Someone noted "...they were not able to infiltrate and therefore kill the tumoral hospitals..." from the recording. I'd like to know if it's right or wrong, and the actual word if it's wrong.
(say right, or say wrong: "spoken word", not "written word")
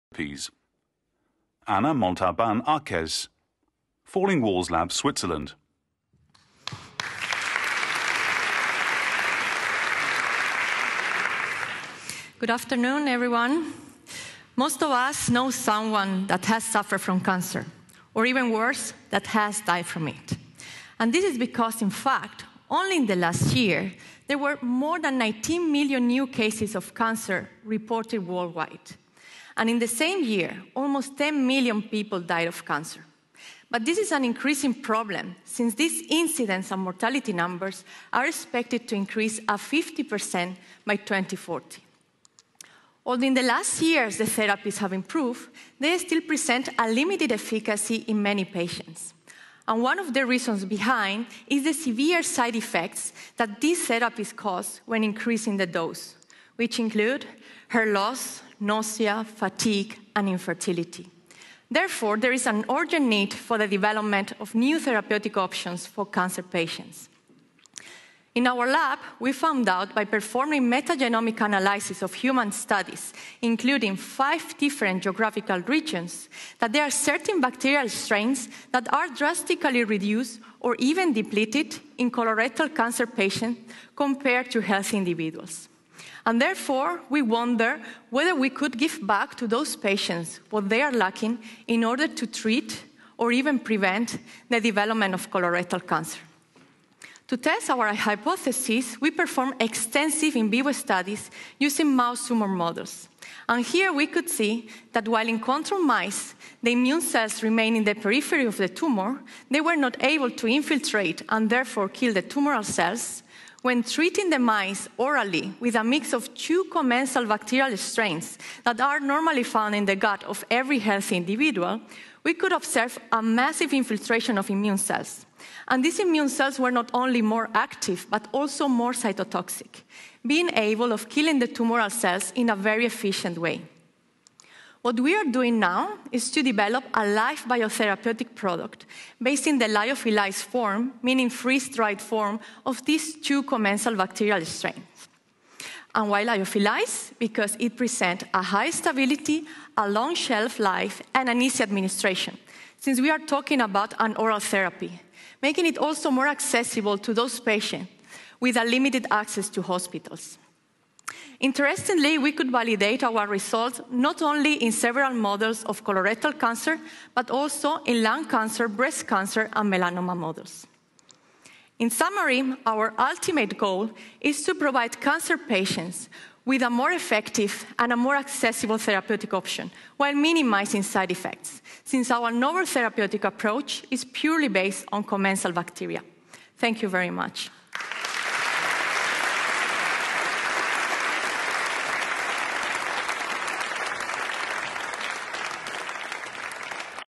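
wrong: "cells", not "hospitals".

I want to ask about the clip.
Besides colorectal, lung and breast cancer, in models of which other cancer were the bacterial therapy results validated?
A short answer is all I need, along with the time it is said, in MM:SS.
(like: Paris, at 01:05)
melanoma, at 02:49.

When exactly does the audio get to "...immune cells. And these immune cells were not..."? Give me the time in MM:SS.
02:04.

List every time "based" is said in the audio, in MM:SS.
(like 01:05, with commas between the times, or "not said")
02:19, 03:04.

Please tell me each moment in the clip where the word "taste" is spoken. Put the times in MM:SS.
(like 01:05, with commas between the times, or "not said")
not said.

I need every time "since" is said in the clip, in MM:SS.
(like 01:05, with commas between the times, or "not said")
00:35, 02:32, 03:01.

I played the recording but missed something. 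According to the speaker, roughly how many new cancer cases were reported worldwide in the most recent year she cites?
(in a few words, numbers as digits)
more than 19 million.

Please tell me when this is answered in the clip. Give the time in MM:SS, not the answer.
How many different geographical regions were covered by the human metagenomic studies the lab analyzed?
01:13.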